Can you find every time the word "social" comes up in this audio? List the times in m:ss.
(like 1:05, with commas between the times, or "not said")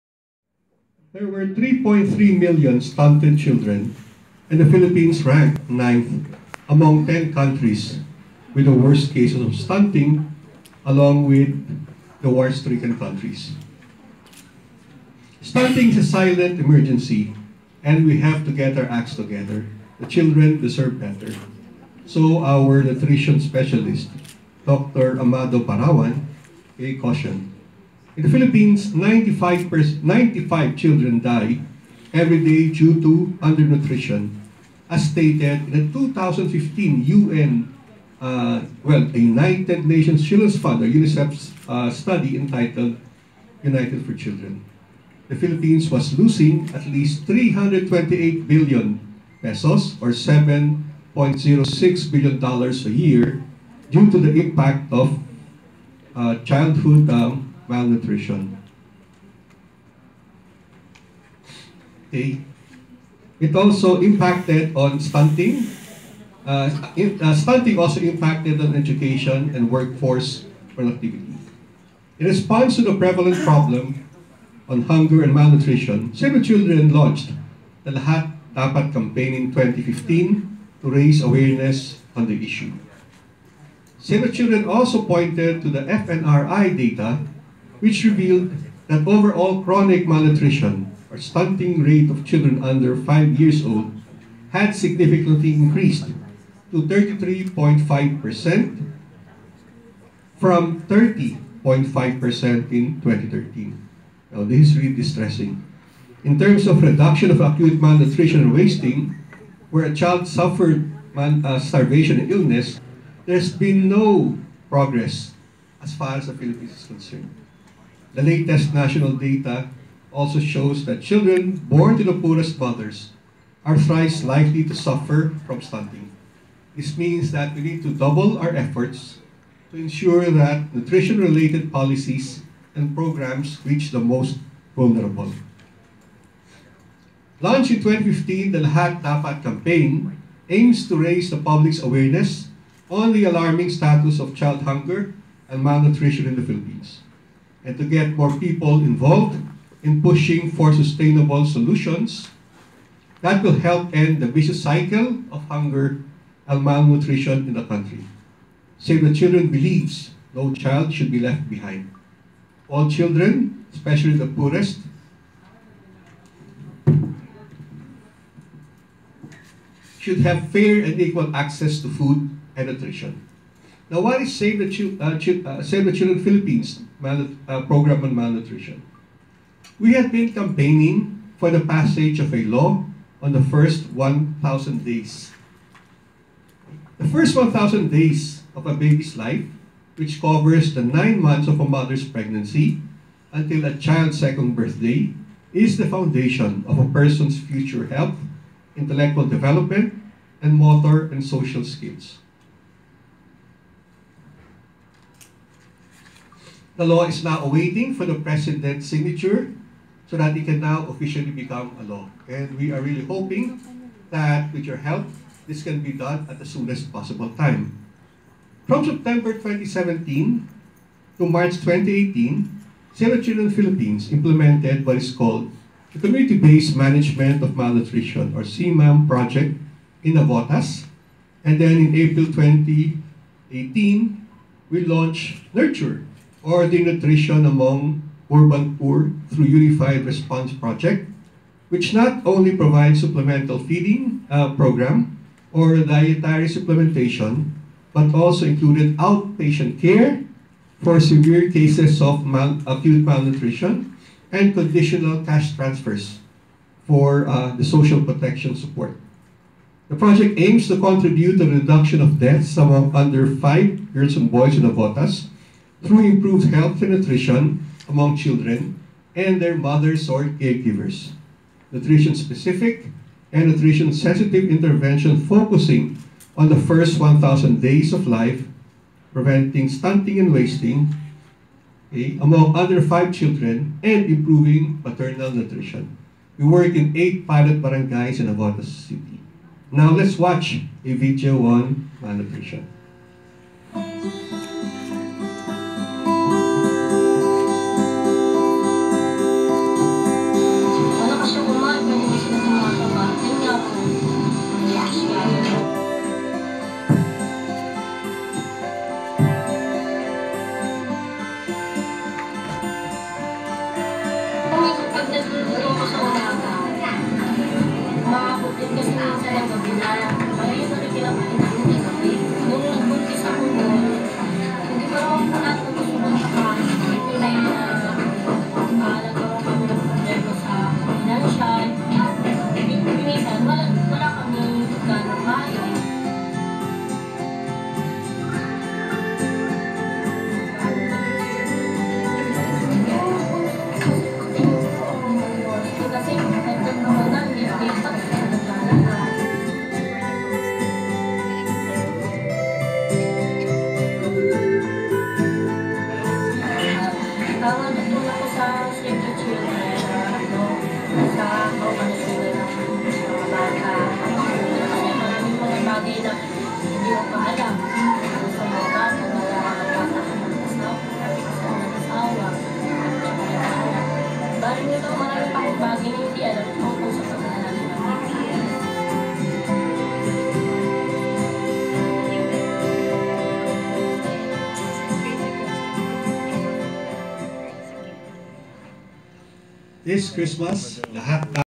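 3:21, 4:17.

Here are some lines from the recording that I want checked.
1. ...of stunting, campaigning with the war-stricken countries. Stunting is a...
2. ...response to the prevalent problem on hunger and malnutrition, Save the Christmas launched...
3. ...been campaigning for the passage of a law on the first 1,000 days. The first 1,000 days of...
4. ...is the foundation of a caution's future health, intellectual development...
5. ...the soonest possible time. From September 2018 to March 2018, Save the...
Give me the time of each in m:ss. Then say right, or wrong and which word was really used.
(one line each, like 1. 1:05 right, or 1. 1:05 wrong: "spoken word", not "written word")
1. 0:09 wrong: "along", not "campaigning"
2. 1:12 wrong: "Children", not "Christmas"
3. 3:00 right
4. 3:15 wrong: "person", not "caution"
5. 3:36 wrong: "2017", not "2018".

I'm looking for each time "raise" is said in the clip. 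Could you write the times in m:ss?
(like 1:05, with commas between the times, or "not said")
1:20, 2:20.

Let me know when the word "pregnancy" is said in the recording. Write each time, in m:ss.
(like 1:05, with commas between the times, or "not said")
3:12.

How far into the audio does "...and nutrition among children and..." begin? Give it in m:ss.
4:26.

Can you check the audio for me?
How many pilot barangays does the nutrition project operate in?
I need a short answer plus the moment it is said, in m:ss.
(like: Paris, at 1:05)
8, at 4:46.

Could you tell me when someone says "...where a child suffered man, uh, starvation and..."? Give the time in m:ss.
1:49.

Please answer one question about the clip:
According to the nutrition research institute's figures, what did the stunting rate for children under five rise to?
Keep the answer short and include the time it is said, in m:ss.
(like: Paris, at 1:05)
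33.5%, at 1:36.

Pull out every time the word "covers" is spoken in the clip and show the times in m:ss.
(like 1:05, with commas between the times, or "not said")
3:10.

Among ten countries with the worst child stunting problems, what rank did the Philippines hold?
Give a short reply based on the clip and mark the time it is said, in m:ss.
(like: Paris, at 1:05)
ninth, at 0:05.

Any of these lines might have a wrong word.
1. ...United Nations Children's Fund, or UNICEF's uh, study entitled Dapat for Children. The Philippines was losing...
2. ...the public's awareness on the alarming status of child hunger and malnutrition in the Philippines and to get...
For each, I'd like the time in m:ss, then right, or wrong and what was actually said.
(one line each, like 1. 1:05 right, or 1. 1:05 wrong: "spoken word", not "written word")
1. 0:39 wrong: "United", not "Dapat"
2. 2:21 right.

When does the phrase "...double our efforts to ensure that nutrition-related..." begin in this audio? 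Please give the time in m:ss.
2:07.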